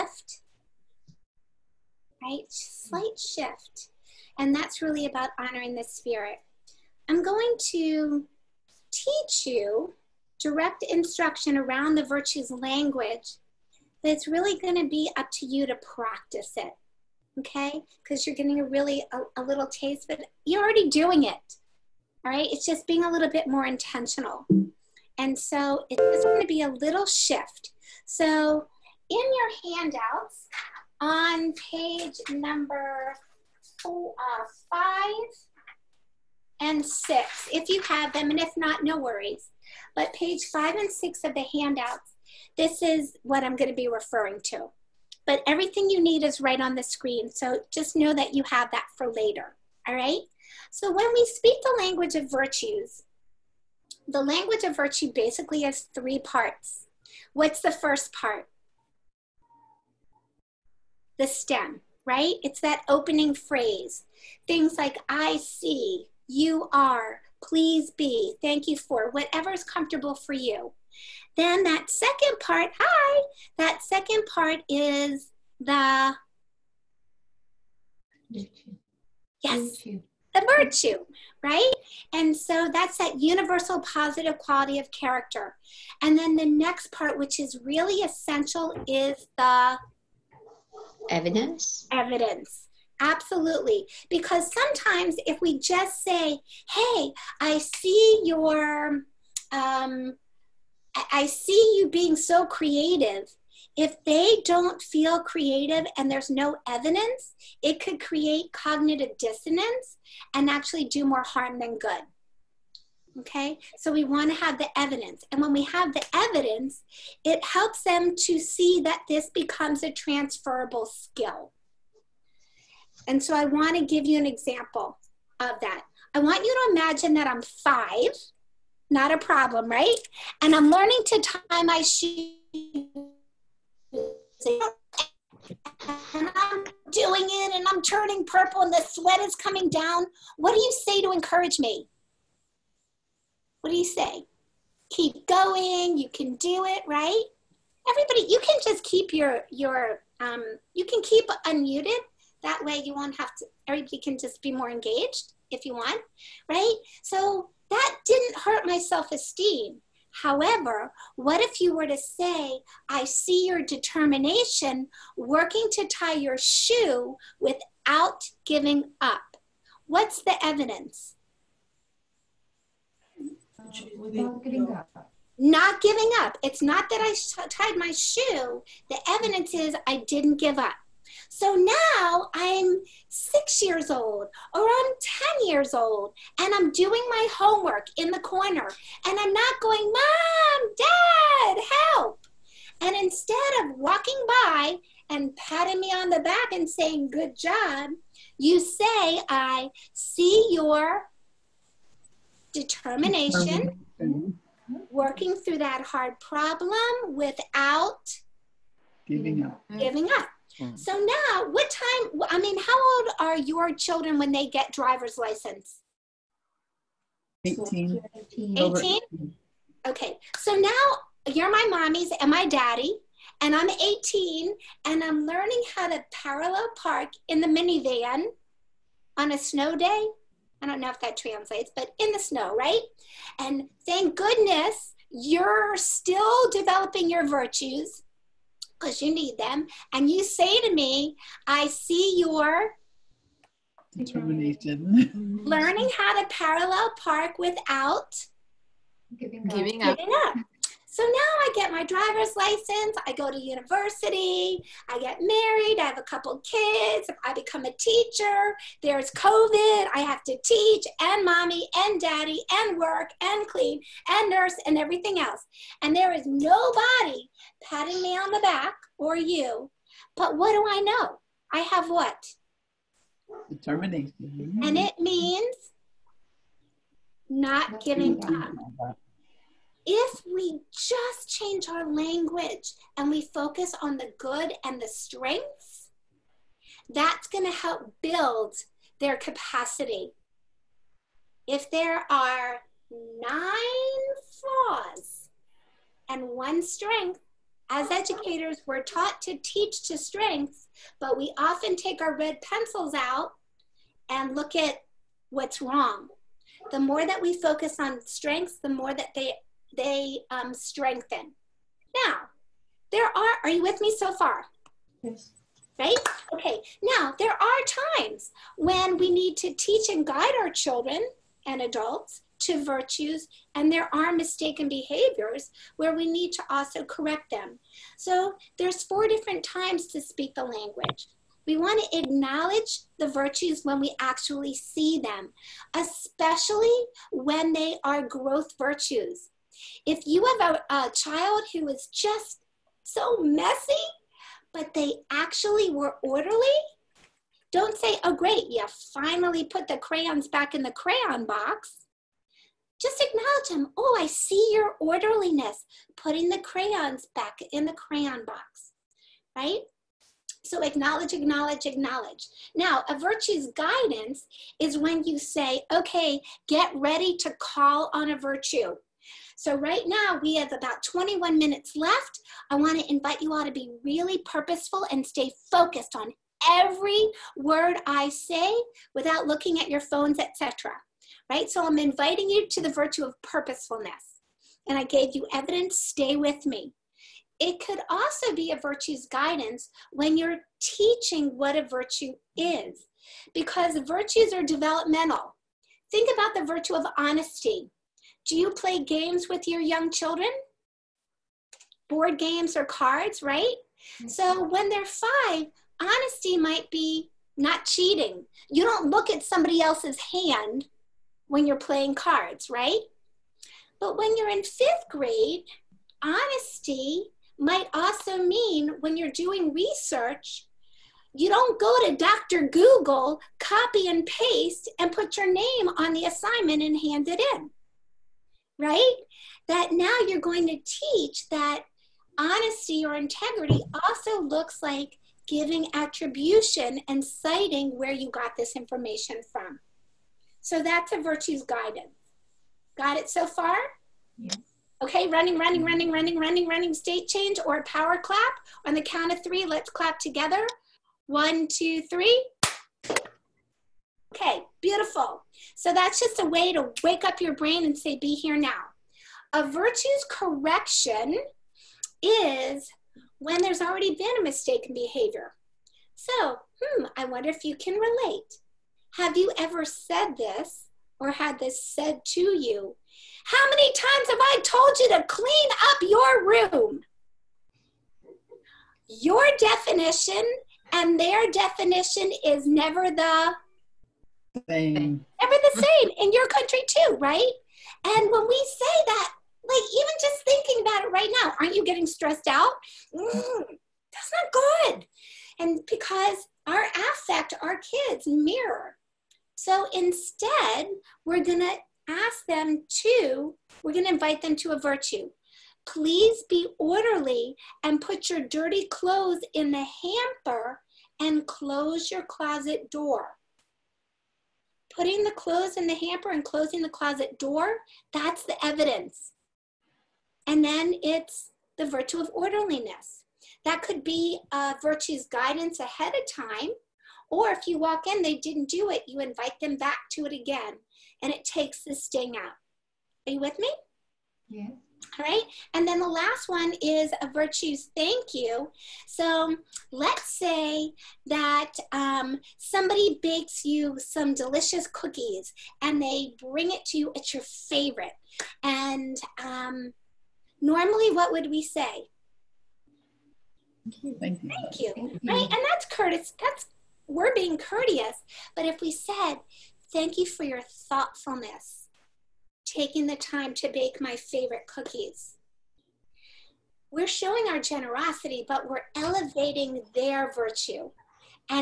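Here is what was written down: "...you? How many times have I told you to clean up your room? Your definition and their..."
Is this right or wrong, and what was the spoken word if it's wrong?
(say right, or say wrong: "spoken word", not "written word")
right.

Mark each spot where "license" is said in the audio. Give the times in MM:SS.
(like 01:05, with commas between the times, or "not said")
03:35, 04:12.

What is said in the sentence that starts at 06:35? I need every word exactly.
Think about the virtue of honesty.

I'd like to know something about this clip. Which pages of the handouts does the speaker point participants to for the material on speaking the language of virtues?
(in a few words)
5 and 6.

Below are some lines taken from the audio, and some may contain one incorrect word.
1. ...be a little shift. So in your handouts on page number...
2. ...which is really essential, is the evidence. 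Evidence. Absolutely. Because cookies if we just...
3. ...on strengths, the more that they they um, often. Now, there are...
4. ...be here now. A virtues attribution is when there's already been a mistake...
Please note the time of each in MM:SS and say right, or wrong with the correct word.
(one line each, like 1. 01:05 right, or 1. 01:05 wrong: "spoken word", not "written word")
1. 00:26 right
2. 01:27 wrong: "sometimes", not "cookies"
3. 05:07 wrong: "strengthen", not "often"
4. 07:37 wrong: "correction", not "attribution".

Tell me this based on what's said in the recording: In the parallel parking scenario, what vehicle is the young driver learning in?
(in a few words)
the minivan.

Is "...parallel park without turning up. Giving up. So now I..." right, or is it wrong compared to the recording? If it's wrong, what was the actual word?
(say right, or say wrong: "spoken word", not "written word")
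wrong: "giving", not "turning".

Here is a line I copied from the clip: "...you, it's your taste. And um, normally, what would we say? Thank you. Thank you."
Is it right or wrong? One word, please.
wrong.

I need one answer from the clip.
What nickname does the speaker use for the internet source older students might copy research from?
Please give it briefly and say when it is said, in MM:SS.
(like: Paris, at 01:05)
Dr. Google, at 07:01.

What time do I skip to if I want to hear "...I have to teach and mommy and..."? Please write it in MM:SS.
04:19.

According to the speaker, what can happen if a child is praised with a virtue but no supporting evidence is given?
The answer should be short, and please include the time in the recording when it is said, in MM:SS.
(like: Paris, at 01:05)
cognitive dissonance, at 01:48.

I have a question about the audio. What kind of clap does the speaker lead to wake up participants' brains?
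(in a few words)
power clap.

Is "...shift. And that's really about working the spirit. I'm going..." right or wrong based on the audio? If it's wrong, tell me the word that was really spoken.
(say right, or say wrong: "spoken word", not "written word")
wrong: "honoring", not "working".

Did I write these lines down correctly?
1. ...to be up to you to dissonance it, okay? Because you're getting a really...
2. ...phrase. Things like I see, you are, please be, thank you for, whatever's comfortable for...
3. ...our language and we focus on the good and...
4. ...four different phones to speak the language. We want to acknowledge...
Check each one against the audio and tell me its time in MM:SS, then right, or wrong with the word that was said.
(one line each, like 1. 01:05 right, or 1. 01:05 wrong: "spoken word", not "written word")
1. 00:14 wrong: "practice", not "dissonance"
2. 01:03 right
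3. 04:41 right
4. 05:28 wrong: "times", not "phones".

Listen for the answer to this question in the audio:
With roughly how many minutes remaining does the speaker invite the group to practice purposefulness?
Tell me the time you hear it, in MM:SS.
06:10.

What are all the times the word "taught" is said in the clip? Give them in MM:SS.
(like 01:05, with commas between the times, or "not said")
04:58.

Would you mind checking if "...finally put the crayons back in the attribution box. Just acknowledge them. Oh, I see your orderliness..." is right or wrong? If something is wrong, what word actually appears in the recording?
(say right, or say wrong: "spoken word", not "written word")
wrong: "crayon", not "attribution".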